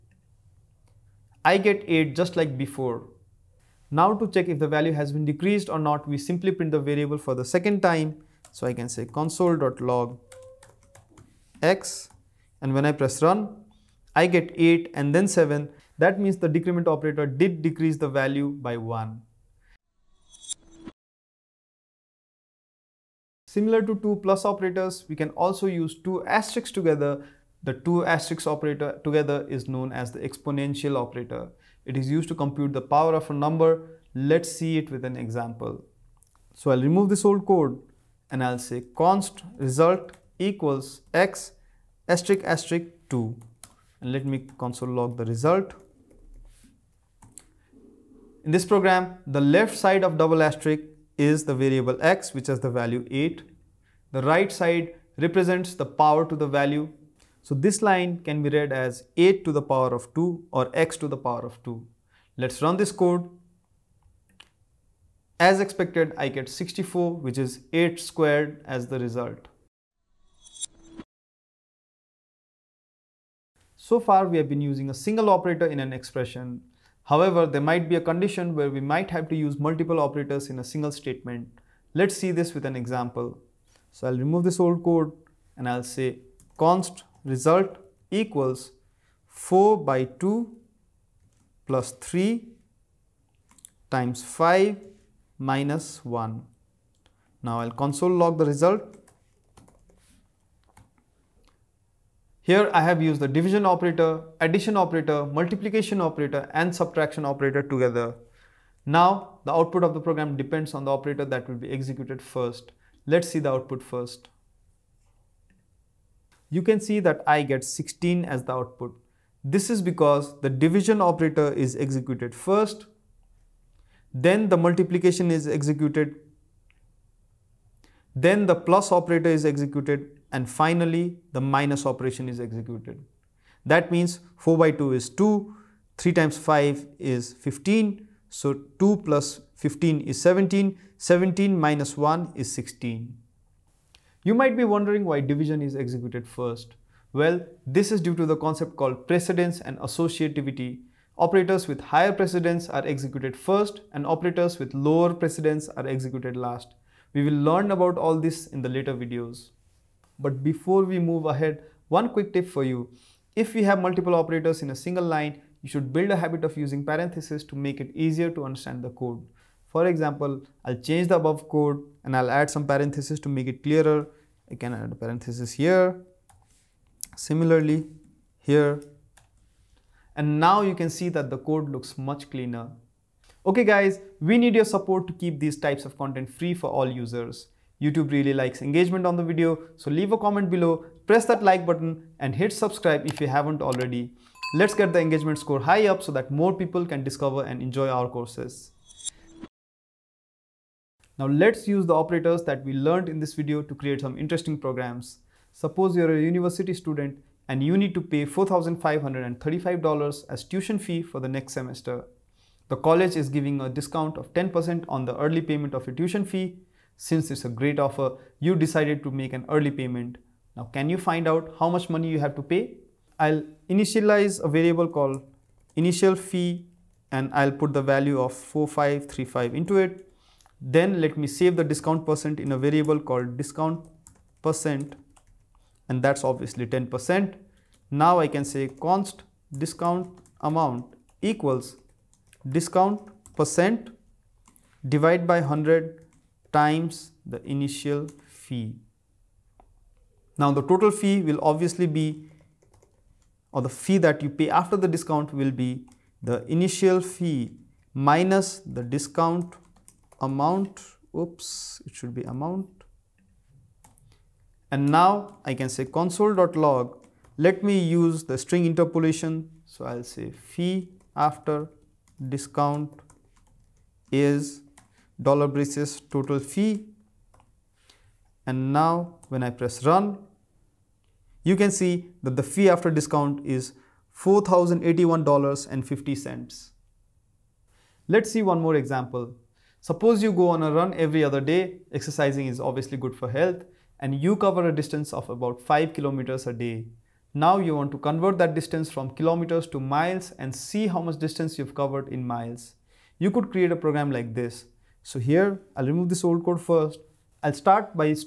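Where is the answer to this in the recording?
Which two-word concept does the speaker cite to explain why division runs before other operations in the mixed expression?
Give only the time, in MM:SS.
02:29.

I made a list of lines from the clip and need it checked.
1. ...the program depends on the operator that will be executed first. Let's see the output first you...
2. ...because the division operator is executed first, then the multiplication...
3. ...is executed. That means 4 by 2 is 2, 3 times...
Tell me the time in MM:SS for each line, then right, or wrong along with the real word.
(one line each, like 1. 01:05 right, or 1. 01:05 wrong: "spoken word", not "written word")
1. 01:49 right
2. 01:59 right
3. 02:12 right.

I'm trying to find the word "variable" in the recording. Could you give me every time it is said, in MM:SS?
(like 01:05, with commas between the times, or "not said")
00:06, 00:51, 03:44, 03:52.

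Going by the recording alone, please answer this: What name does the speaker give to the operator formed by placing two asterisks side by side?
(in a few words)
exponential operator.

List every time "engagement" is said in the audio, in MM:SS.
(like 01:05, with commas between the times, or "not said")
03:08, 03:14.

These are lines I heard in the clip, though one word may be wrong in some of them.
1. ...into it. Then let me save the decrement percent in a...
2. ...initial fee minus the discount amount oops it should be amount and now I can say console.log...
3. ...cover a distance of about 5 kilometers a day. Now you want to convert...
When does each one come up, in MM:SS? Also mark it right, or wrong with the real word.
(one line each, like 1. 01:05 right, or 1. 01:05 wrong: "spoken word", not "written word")
1. 03:49 wrong: "discount", not "decrement"
2. 04:16 right
3. 04:54 right.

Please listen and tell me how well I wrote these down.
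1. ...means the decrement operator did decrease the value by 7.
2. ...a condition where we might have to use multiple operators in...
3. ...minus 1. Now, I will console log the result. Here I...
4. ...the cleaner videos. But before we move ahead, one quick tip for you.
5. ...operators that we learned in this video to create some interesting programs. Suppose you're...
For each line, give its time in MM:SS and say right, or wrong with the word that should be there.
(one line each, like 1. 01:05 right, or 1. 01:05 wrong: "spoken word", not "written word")
1. 00:16 wrong: "1", not "7"
2. 01:17 right
3. 01:35 right
4. 02:38 wrong: "later", not "cleaner"
5. 03:21 right.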